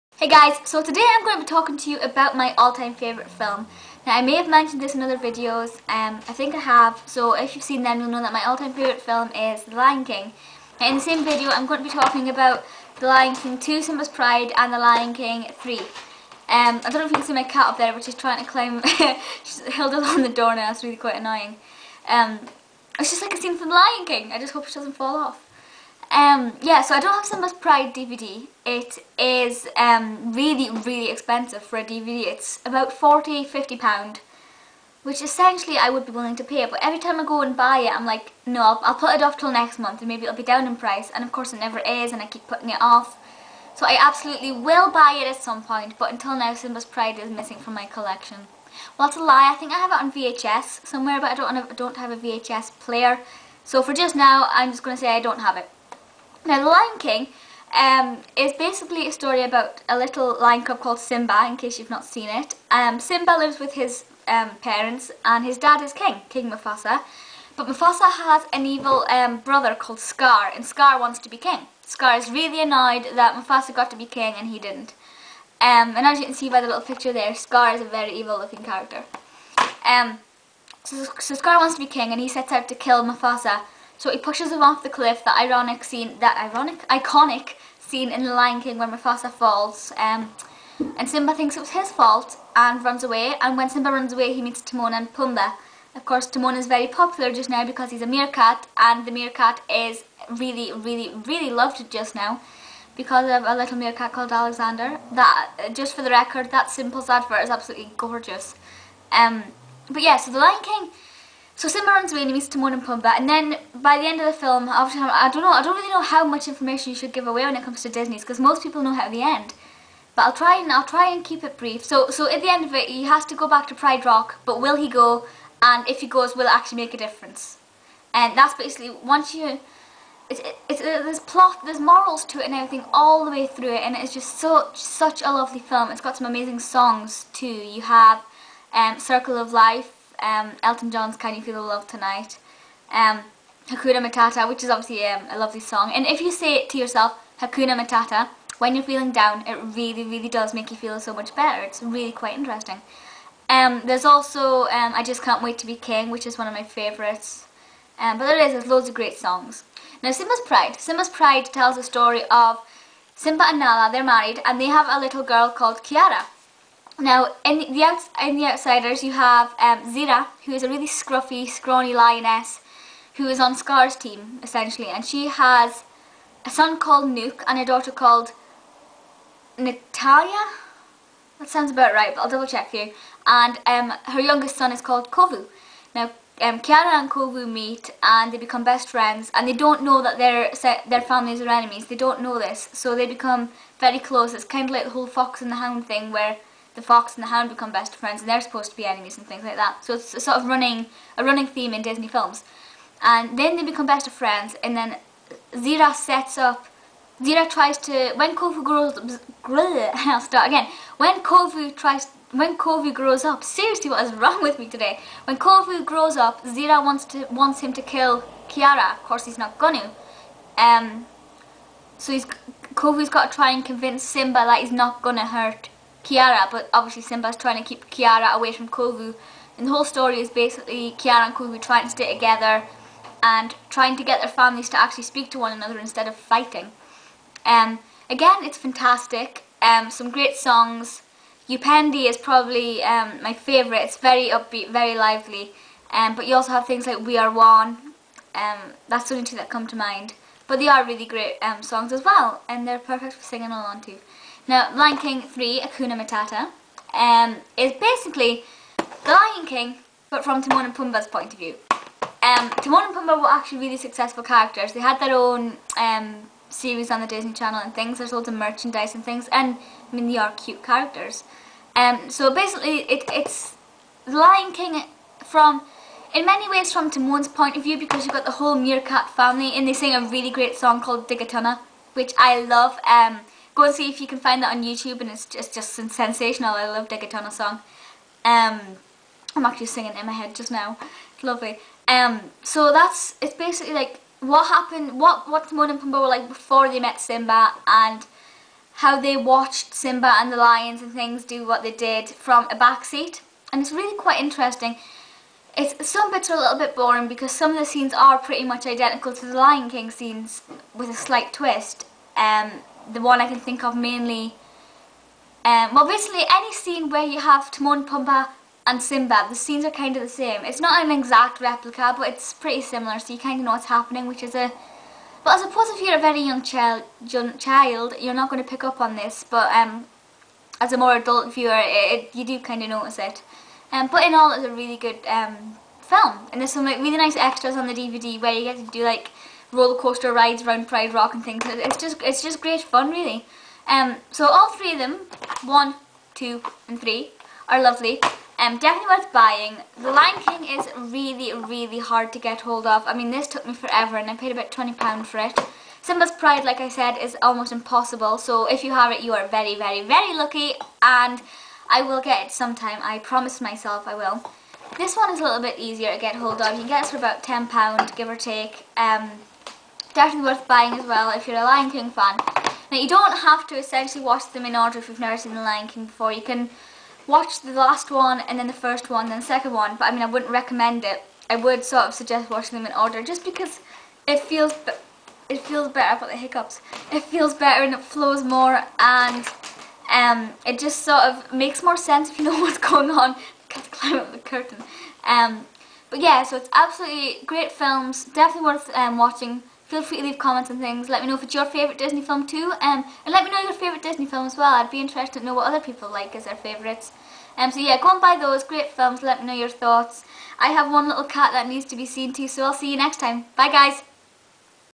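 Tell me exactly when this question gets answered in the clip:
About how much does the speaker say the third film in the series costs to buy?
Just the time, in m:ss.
6:07.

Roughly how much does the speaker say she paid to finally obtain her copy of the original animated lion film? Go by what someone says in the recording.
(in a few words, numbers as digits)
£20.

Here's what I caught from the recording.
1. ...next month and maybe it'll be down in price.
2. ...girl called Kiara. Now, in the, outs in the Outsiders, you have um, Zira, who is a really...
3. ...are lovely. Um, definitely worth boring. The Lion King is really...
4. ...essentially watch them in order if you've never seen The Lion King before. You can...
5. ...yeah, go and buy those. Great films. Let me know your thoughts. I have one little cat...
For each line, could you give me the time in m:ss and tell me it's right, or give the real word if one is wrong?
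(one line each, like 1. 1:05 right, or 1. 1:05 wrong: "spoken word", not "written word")
1. 0:39 right
2. 2:45 right
3. 5:47 wrong: "buying", not "boring"
4. 6:13 right
5. 6:47 right.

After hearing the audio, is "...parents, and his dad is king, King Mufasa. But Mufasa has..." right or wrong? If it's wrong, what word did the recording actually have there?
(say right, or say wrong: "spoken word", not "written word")
right.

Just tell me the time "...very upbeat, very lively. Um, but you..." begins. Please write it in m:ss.
4:03.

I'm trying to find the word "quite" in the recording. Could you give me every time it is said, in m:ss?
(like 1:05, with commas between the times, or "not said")
0:20, 2:32, 5:03.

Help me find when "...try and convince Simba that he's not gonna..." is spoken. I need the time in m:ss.
3:43.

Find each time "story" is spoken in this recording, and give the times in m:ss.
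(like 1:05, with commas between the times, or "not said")
0:59, 2:41, 3:49.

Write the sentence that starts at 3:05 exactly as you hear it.
Now, um, and Kovu meet and they become best friends and they don't know that their their families are enemies.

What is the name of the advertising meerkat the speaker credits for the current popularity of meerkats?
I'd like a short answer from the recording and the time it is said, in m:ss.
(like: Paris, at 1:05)
Alexander, at 1:44.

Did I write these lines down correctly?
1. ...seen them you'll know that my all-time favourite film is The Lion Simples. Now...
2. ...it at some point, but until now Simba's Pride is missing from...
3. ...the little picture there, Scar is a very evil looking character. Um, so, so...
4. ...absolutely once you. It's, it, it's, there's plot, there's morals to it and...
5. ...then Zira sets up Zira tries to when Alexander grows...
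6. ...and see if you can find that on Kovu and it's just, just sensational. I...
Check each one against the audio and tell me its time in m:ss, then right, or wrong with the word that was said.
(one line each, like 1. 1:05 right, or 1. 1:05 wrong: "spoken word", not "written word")
1. 0:07 wrong: "King", not "Simples"
2. 0:45 right
3. 1:16 right
4. 2:08 wrong: "basically", not "absolutely"
5. 3:24 wrong: "Kovu", not "Alexander"
6. 4:43 wrong: "YouTube", not "Kovu".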